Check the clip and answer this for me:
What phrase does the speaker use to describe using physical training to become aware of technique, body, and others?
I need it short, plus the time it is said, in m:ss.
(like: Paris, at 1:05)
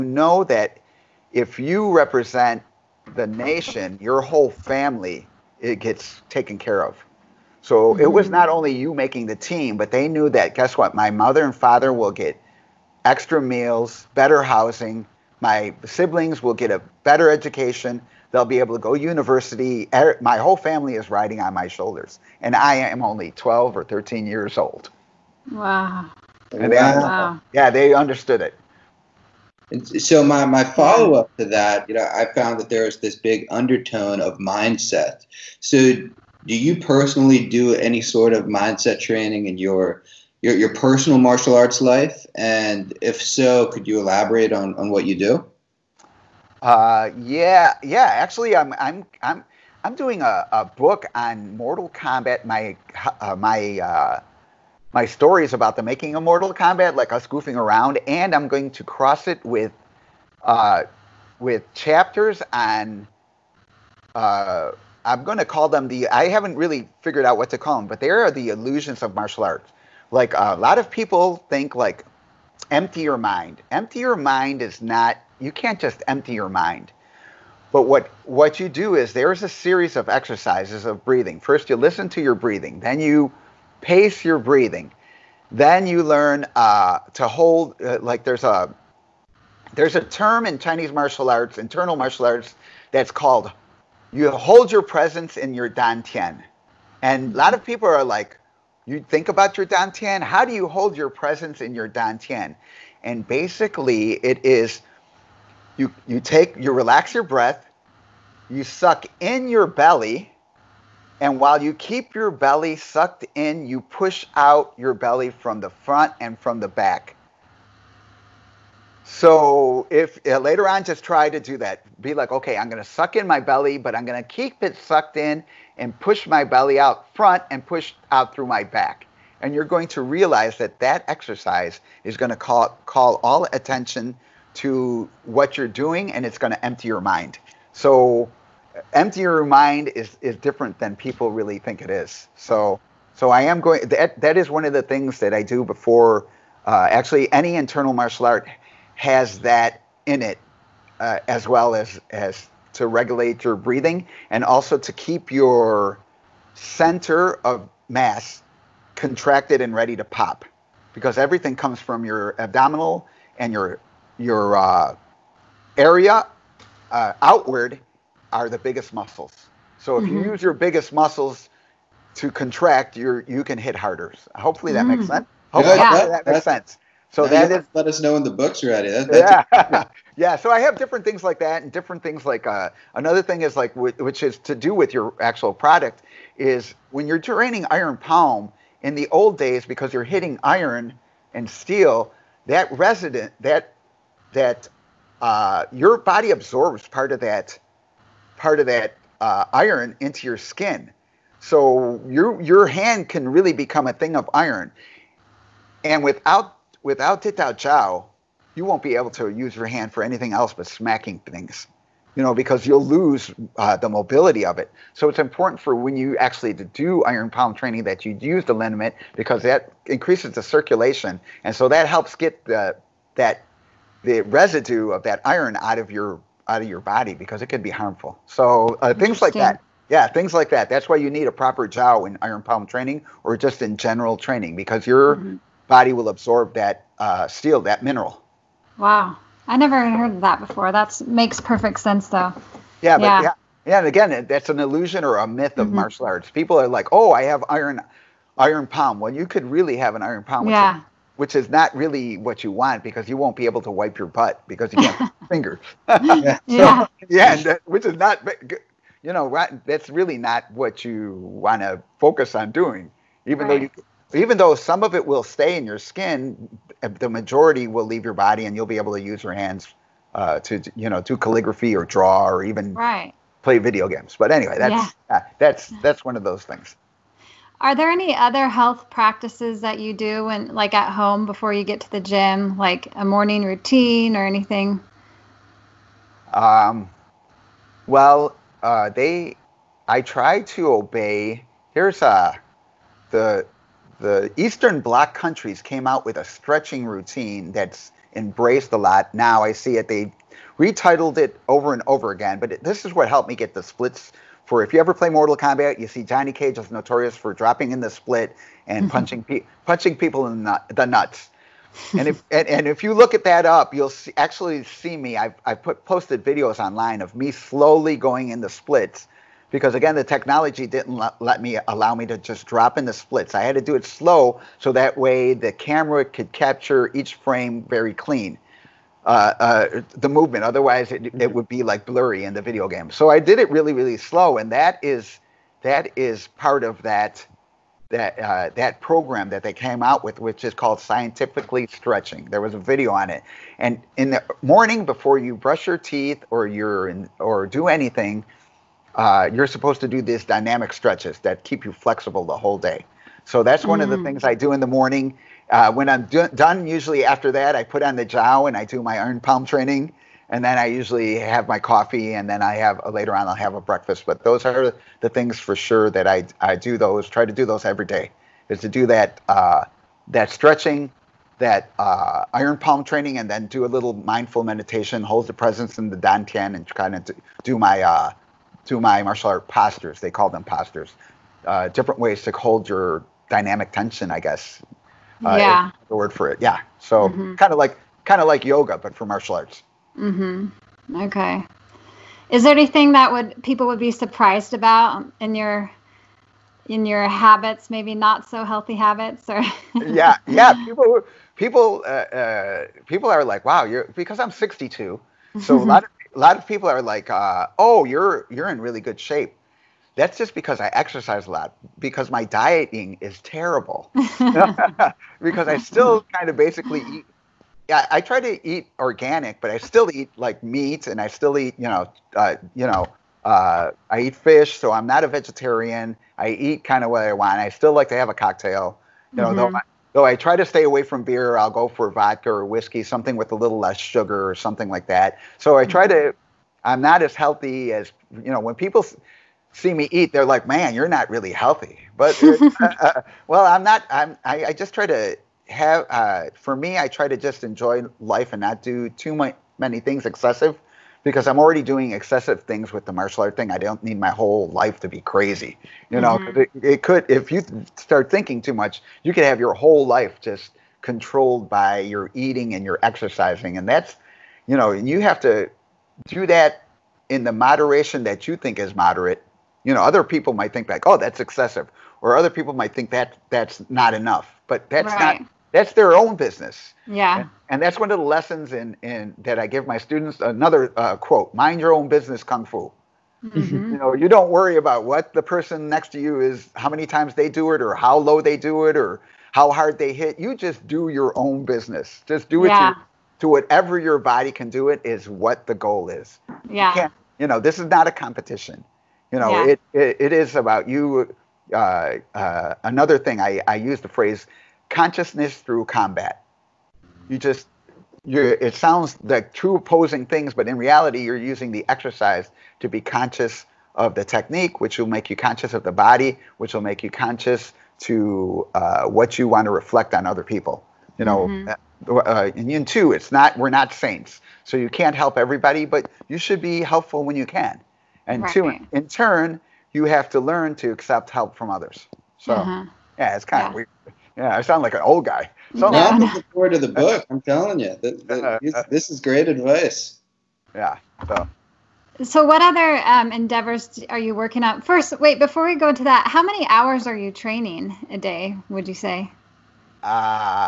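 Consciousness through combat, at 8:24.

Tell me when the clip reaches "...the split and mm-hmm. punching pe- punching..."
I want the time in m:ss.
5:07.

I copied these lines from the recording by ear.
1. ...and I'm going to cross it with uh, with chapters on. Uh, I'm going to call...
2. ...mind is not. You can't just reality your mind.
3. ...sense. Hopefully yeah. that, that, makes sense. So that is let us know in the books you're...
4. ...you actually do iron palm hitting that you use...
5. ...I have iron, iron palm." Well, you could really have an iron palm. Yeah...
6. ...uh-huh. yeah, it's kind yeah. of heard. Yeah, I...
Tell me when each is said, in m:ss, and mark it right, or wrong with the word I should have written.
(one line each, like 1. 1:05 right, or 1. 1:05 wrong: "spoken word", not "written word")
1. 0:58 right
2. 1:14 wrong: "empty", not "reality"
3. 2:55 right
4. 3:35 wrong: "training", not "hitting"
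5. 4:07 right
6. 8:52 wrong: "weird", not "heard".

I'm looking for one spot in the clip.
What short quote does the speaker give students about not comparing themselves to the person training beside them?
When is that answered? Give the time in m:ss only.
8:01.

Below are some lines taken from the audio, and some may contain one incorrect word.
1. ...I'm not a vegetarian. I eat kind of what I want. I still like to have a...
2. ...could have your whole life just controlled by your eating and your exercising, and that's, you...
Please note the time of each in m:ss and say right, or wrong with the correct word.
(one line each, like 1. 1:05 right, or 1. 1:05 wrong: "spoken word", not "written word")
1. 7:04 right
2. 7:39 right.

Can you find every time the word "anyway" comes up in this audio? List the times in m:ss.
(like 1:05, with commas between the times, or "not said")
4:34.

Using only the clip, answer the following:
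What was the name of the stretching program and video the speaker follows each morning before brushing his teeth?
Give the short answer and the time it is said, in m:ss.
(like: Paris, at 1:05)
Scientifically stretching, at 5:40.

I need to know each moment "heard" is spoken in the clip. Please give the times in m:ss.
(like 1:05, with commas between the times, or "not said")
3:59.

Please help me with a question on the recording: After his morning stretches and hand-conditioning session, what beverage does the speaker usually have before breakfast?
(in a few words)
Coffee.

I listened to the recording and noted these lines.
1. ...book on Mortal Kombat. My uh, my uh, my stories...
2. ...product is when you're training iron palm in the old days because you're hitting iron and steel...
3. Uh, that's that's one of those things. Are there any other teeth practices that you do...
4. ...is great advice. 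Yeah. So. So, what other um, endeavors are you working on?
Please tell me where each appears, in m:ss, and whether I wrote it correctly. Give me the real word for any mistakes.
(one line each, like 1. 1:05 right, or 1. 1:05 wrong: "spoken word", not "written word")
1. 0:50 right
2. 3:05 right
3. 4:35 wrong: "health", not "teeth"
4. 8:58 right.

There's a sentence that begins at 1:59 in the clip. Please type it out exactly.
So if uh, later on, just try to do that.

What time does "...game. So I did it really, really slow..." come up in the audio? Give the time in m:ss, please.
5:32.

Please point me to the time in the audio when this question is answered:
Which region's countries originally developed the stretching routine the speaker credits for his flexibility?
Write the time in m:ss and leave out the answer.
4:54.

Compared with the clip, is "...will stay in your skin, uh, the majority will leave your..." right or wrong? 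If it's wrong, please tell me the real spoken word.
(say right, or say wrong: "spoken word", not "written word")
right.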